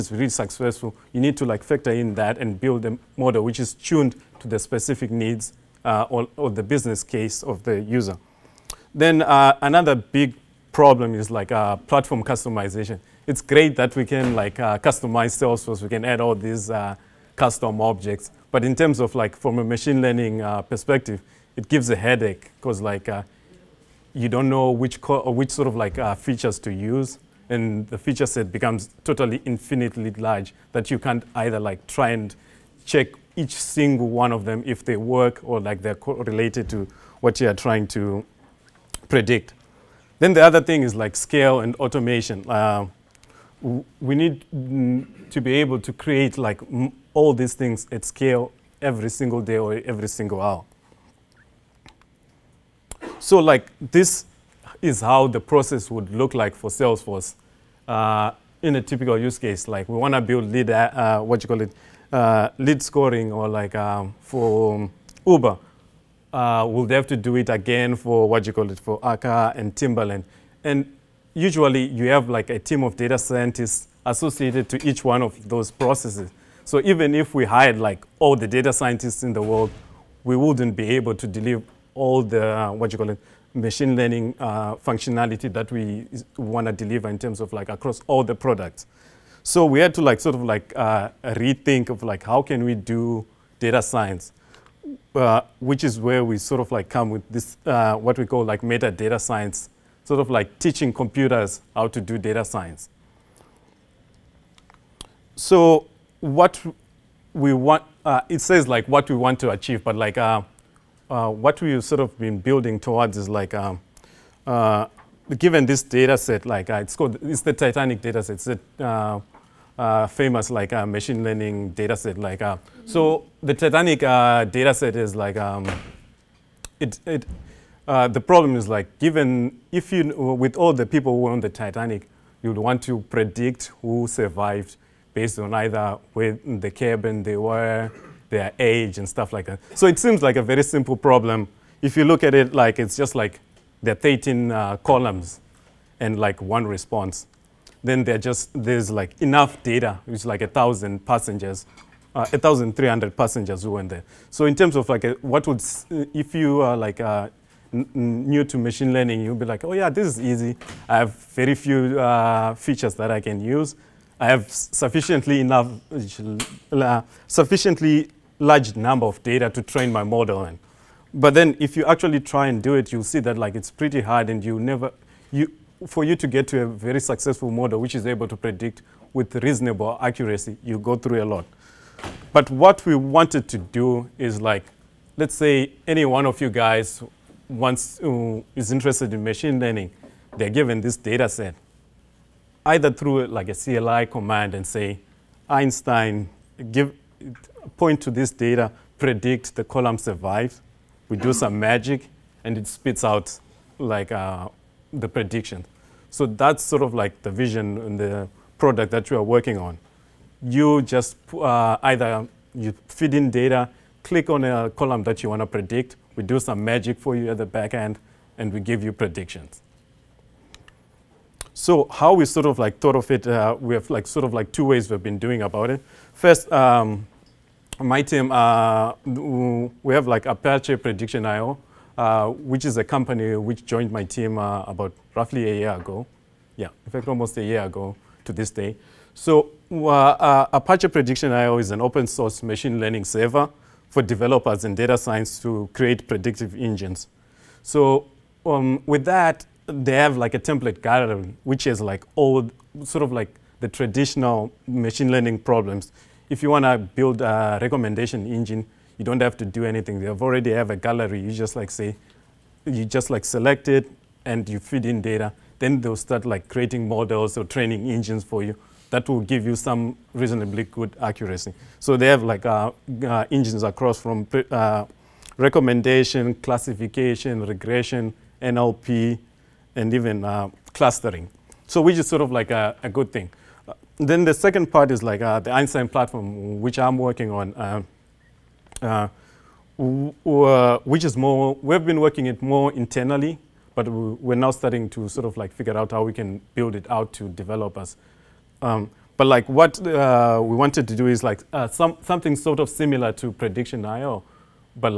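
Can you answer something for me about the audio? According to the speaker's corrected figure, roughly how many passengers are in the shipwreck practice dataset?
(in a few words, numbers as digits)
1,300.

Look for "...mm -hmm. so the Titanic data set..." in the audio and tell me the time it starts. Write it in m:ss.
2:02.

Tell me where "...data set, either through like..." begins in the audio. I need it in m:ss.
3:10.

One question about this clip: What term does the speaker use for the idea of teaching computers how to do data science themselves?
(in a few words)
meta data science.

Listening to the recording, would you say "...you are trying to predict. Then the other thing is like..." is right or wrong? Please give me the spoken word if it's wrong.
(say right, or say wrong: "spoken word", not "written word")
right.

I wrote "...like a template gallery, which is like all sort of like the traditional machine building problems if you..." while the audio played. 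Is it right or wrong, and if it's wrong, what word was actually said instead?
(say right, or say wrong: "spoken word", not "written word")
wrong: "learning", not "building".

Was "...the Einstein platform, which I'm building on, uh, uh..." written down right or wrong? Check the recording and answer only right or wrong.
wrong.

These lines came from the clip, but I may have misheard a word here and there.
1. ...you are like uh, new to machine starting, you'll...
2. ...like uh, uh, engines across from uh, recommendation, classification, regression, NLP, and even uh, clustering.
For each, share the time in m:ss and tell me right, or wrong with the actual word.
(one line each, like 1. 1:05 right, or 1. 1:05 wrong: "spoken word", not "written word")
1. 2:36 wrong: "learning", not "starting"
2. 4:32 right.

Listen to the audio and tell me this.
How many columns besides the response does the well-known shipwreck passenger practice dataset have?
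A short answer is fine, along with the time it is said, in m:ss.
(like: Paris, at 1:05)
13, at 2:23.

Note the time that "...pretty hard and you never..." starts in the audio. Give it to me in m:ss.
2:53.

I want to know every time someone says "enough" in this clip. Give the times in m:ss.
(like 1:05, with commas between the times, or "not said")
2:29, 2:45.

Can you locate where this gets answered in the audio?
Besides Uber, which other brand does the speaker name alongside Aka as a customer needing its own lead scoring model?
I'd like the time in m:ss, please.
1:09.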